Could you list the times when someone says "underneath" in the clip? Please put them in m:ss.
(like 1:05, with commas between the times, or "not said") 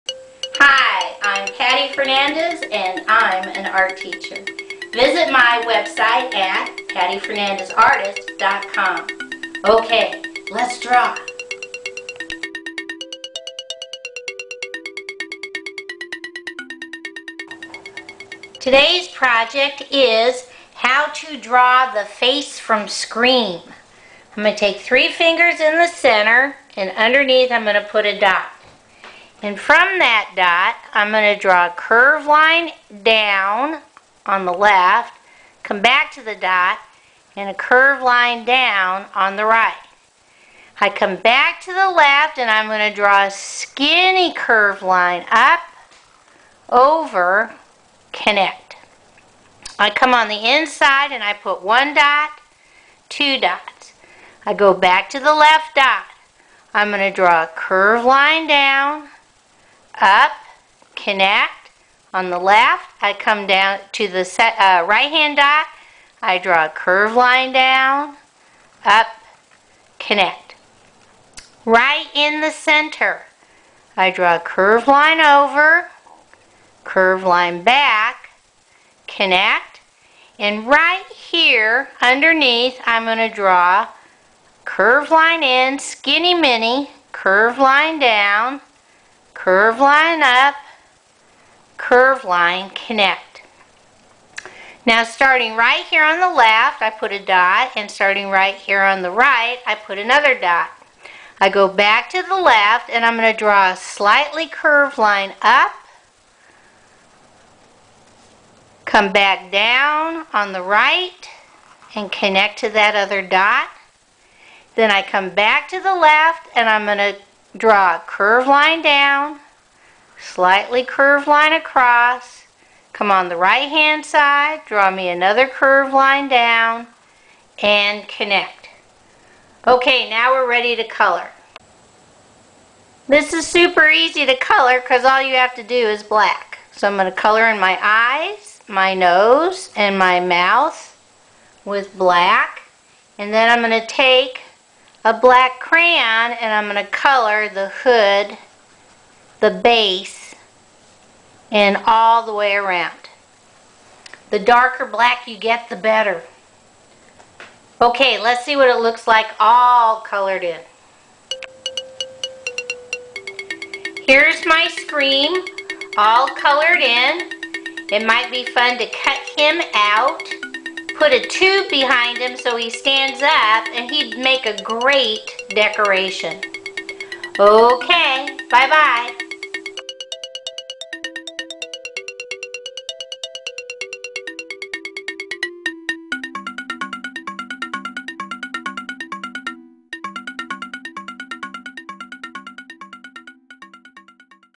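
0:26, 1:22.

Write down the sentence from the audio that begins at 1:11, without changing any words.
Right in the center, I draw a curve line over, curve line back, connect.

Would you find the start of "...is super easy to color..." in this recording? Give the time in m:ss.
2:13.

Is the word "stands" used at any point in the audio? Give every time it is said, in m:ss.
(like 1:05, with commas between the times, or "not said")
2:52.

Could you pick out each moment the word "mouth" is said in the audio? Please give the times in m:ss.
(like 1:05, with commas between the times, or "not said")
2:20.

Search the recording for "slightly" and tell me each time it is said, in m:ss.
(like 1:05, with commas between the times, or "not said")
1:43, 2:00.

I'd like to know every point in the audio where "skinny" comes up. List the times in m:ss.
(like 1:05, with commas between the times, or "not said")
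0:43, 1:25.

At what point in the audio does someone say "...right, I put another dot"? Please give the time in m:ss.
1:39.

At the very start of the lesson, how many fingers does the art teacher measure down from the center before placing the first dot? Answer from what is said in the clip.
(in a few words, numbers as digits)
3.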